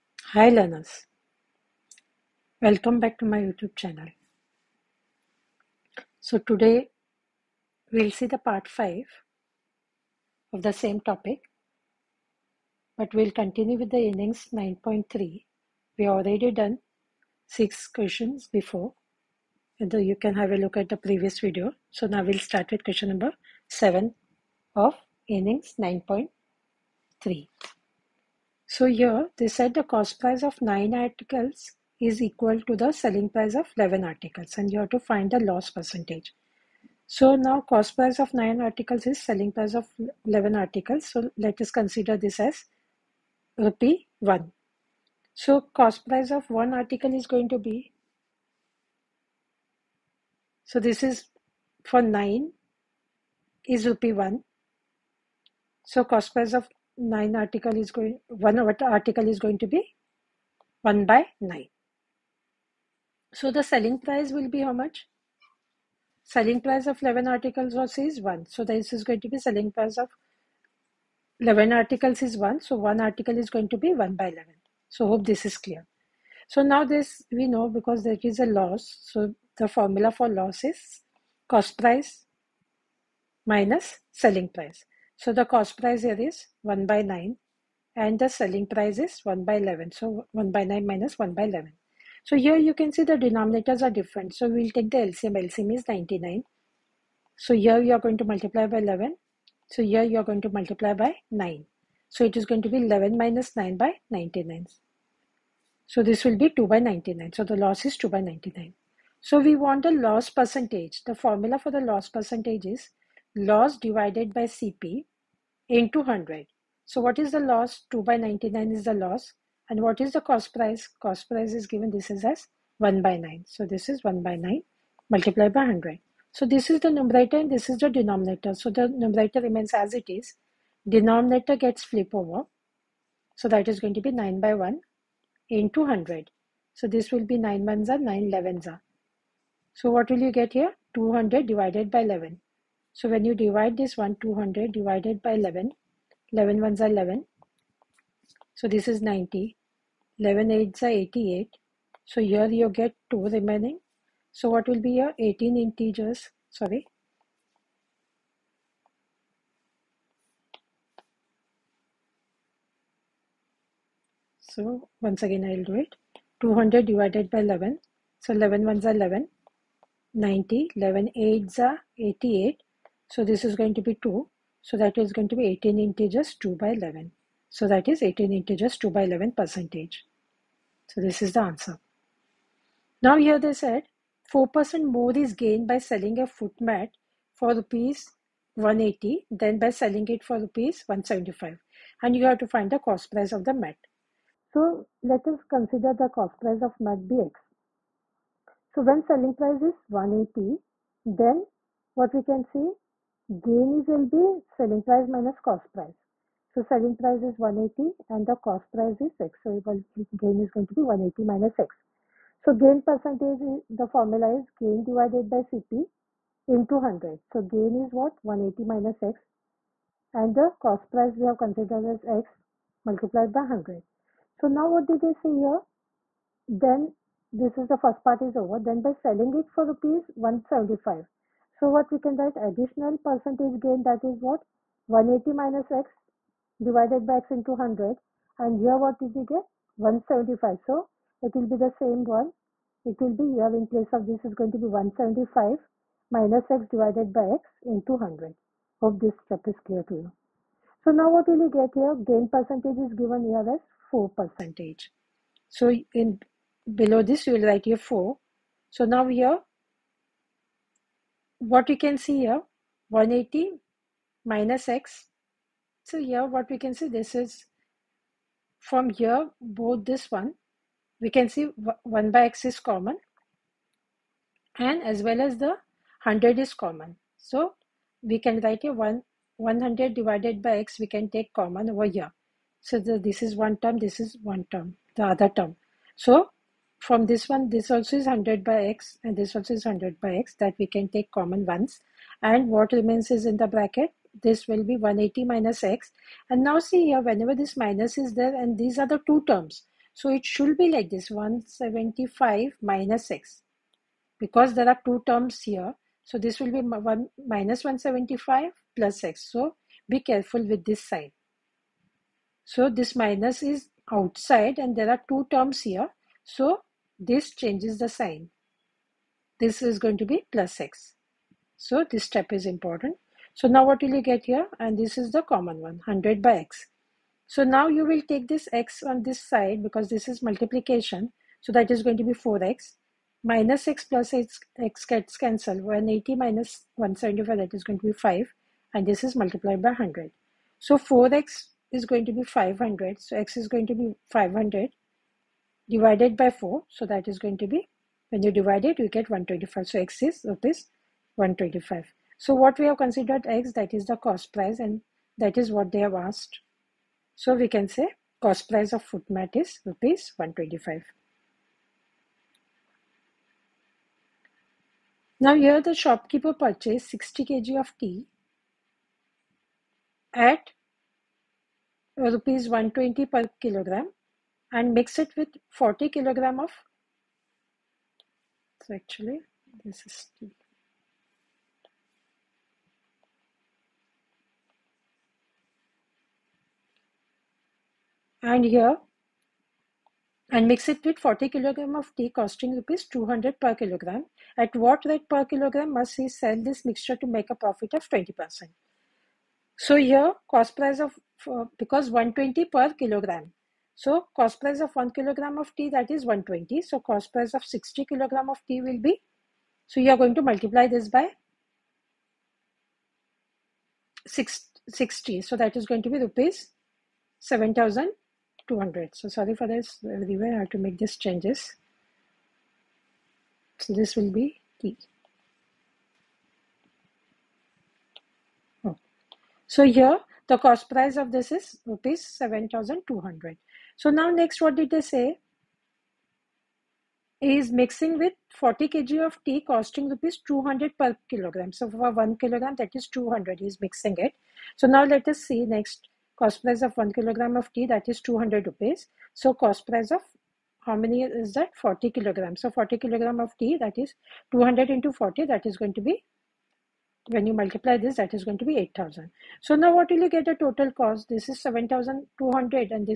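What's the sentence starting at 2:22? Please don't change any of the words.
So when you divide this one, 200 divided by 11, 11 ones are 11.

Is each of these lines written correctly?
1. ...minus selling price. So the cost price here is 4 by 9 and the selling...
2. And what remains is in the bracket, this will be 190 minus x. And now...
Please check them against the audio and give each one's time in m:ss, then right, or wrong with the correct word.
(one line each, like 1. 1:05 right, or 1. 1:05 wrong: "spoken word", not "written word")
1. 1:23 wrong: "1", not "4"
2. 4:52 wrong: "180", not "190".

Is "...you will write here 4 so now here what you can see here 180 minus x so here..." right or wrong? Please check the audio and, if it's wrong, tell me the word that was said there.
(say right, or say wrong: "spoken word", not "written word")
right.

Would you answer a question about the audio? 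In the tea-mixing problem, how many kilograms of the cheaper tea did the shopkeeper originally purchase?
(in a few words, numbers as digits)
60 kg.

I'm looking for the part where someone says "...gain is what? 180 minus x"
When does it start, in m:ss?
3:37.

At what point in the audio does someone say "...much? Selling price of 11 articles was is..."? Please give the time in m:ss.
1:04.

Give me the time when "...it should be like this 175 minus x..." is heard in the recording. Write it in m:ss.
5:00.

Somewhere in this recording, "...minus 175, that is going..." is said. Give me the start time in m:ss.
5:36.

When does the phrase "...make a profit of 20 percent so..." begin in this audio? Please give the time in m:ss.
6:37.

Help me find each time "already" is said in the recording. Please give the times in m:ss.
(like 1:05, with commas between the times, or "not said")
0:16.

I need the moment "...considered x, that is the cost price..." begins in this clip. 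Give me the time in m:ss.
5:52.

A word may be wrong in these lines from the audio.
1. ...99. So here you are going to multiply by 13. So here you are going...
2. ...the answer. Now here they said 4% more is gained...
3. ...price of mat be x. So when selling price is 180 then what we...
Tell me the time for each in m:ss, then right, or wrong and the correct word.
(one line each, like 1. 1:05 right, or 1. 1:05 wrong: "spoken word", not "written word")
1. 1:35 wrong: "11", not "13"
2. 3:01 right
3. 3:16 right.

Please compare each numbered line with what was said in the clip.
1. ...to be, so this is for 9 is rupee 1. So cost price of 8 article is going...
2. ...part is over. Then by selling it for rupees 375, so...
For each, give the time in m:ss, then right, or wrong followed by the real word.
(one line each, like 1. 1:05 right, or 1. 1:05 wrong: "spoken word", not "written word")
1. 0:47 wrong: "9", not "8"
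2. 3:48 wrong: "175", not "375".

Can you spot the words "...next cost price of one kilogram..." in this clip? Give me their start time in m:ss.
7:25.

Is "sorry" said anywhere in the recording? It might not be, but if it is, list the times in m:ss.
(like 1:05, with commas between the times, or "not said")
2:36, 6:59.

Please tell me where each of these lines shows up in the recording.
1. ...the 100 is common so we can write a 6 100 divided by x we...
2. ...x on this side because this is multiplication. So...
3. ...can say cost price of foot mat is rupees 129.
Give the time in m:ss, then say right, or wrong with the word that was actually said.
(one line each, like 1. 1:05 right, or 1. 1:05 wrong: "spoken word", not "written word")
1. 4:35 wrong: "1", not "6"
2. 5:28 right
3. 5:57 wrong: "125", not "129".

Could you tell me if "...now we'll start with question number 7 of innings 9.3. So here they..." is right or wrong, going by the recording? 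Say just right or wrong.
right.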